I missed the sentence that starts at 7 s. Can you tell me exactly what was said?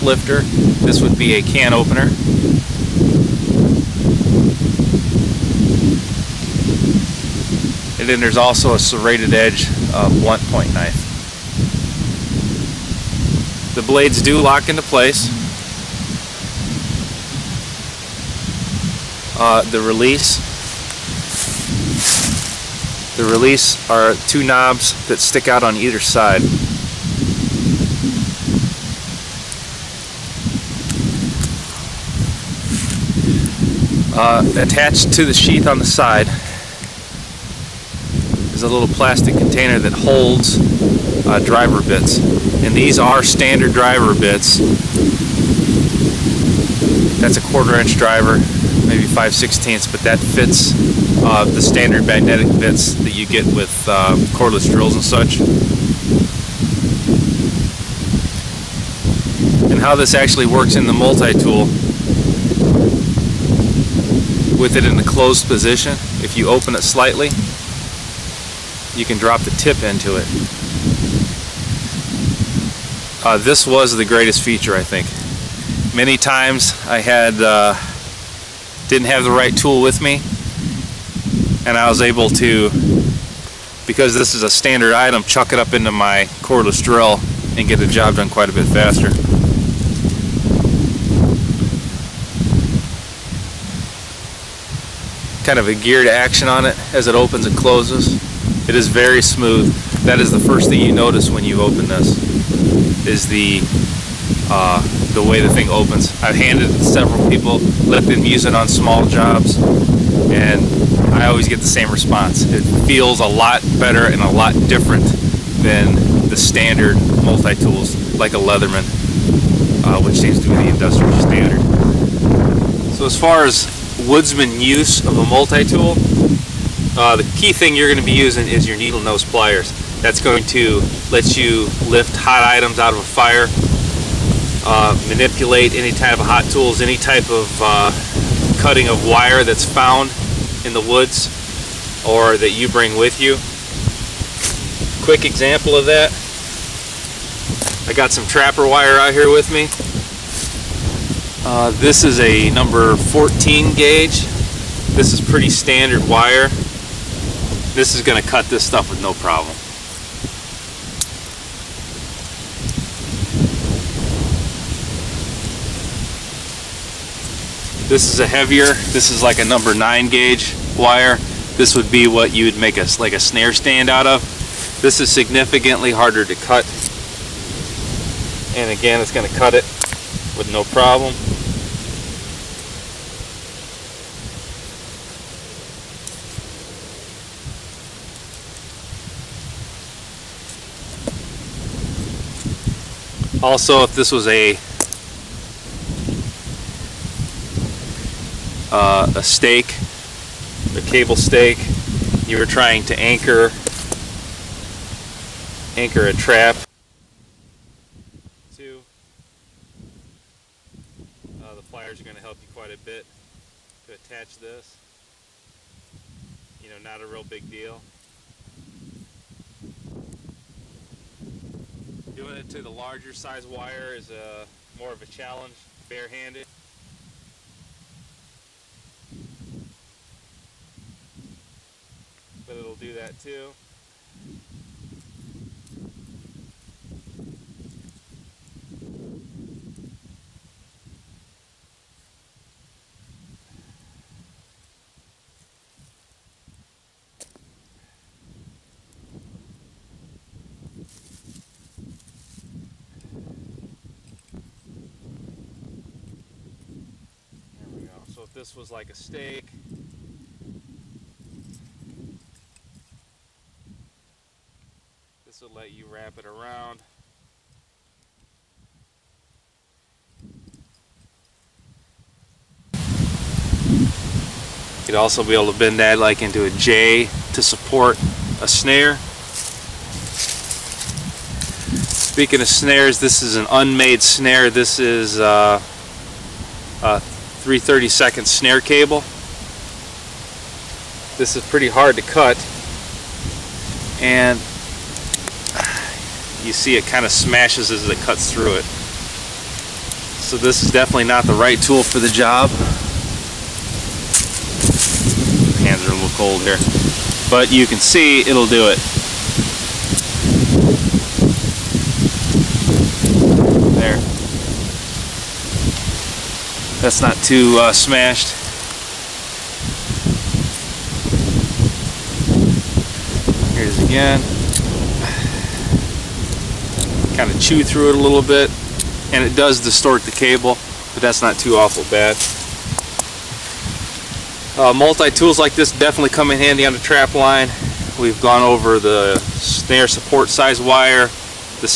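And then there's also a serrated edge uh, blunt point knife the blades do lock into place.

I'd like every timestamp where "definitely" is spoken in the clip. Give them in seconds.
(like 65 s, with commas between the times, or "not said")
300 s, 335 s.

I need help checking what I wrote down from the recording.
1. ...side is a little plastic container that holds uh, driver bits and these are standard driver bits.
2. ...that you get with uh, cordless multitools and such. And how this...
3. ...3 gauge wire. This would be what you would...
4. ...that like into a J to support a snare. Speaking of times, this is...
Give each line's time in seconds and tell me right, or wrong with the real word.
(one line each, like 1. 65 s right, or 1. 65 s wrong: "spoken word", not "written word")
1. 35 s right
2. 52 s wrong: "drills", not "multitools"
3. 169 s wrong: "9", not "3"
4. 275 s wrong: "snares", not "times".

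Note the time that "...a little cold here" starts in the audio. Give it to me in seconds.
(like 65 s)
305 s.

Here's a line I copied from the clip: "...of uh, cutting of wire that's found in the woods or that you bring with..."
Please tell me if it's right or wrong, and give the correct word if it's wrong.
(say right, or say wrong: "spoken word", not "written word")
right.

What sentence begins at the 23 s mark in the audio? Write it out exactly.
The release are two knobs that stick out on either side.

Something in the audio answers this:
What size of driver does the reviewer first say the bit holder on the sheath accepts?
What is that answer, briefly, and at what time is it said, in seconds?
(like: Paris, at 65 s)
quarter inch, at 47 s.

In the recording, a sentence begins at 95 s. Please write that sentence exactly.
Kind of a geared action on it as it opens and closes.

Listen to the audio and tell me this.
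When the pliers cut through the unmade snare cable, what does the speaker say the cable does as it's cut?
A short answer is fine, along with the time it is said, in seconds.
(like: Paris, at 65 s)
smashes, at 297 s.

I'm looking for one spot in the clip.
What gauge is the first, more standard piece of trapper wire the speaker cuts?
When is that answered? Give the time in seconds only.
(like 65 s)
152 s.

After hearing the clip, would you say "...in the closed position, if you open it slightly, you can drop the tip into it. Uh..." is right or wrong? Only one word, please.
right.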